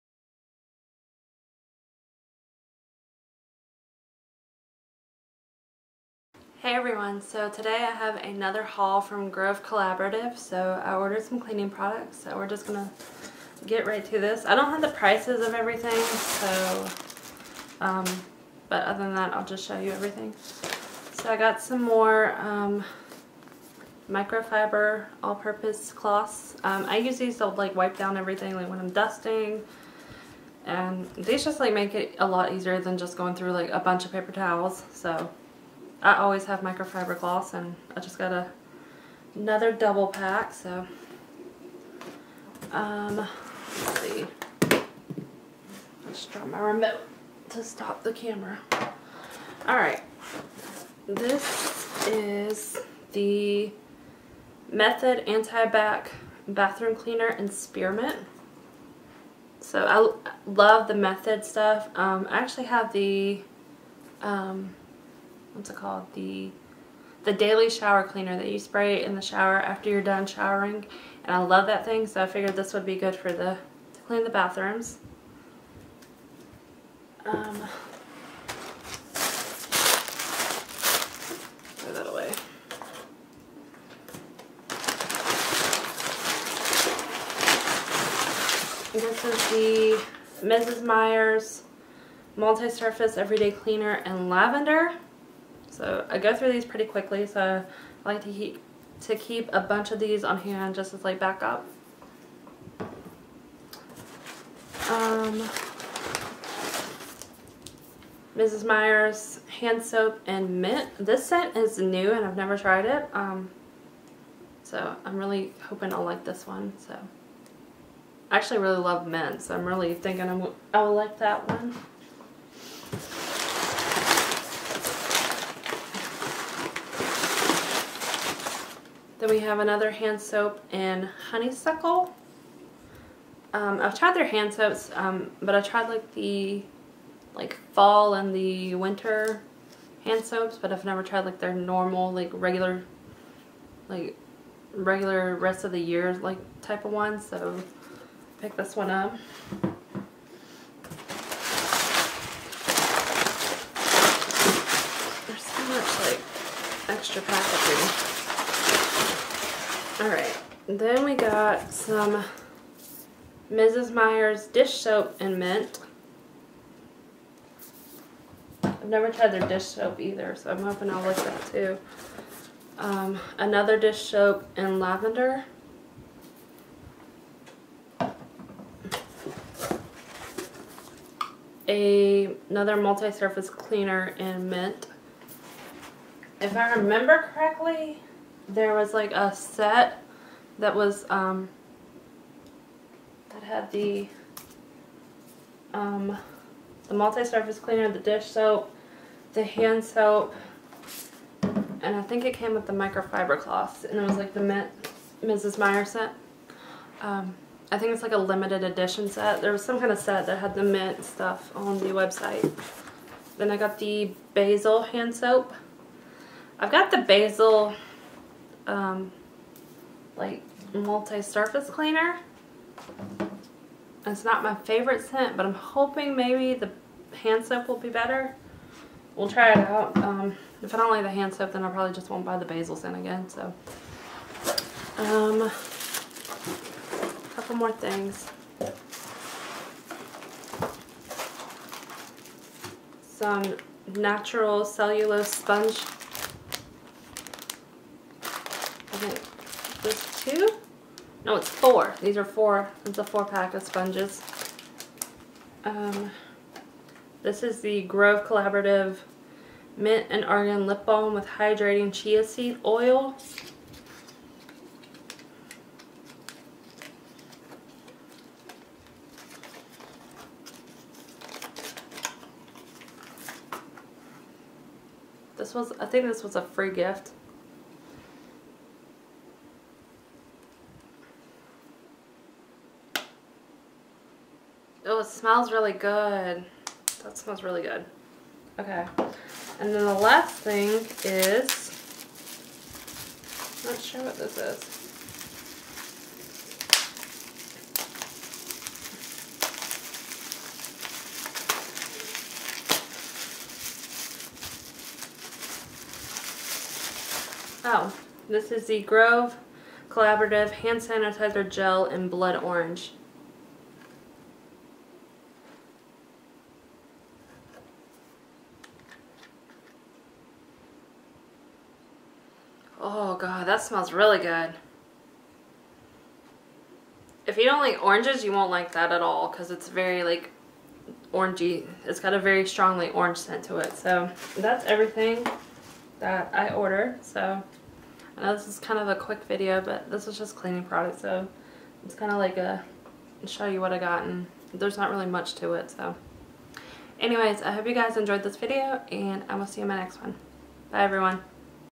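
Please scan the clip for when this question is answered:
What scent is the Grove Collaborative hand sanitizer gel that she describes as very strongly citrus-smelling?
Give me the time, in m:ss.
5:12.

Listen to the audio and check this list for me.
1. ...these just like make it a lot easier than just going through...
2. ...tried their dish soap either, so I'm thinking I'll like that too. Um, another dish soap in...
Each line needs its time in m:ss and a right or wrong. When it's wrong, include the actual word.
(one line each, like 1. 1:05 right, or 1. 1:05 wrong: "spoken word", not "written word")
1. 0:31 right
2. 2:49 wrong: "hoping", not "thinking".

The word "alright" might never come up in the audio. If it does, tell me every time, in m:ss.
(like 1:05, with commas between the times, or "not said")
0:49, 2:40.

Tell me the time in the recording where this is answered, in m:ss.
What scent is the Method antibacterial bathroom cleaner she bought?
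0:57.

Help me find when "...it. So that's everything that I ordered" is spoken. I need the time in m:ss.
5:33.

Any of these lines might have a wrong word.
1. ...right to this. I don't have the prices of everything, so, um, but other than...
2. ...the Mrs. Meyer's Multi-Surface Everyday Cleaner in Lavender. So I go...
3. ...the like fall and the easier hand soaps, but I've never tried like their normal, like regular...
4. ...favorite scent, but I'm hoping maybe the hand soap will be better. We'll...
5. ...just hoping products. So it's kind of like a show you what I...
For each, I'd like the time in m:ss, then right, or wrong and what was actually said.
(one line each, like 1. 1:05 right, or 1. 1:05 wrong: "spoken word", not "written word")
1. 0:13 right
2. 1:29 right
3. 2:16 wrong: "winter", not "easier"
4. 3:44 right
5. 5:40 wrong: "cleaning", not "hoping".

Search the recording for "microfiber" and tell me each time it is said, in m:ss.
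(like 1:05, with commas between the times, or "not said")
0:24, 0:36, 3:22.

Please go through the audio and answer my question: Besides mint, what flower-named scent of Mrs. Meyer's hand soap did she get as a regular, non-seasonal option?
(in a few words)
Honeysuckle.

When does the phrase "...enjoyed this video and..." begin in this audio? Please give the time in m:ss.
5:47.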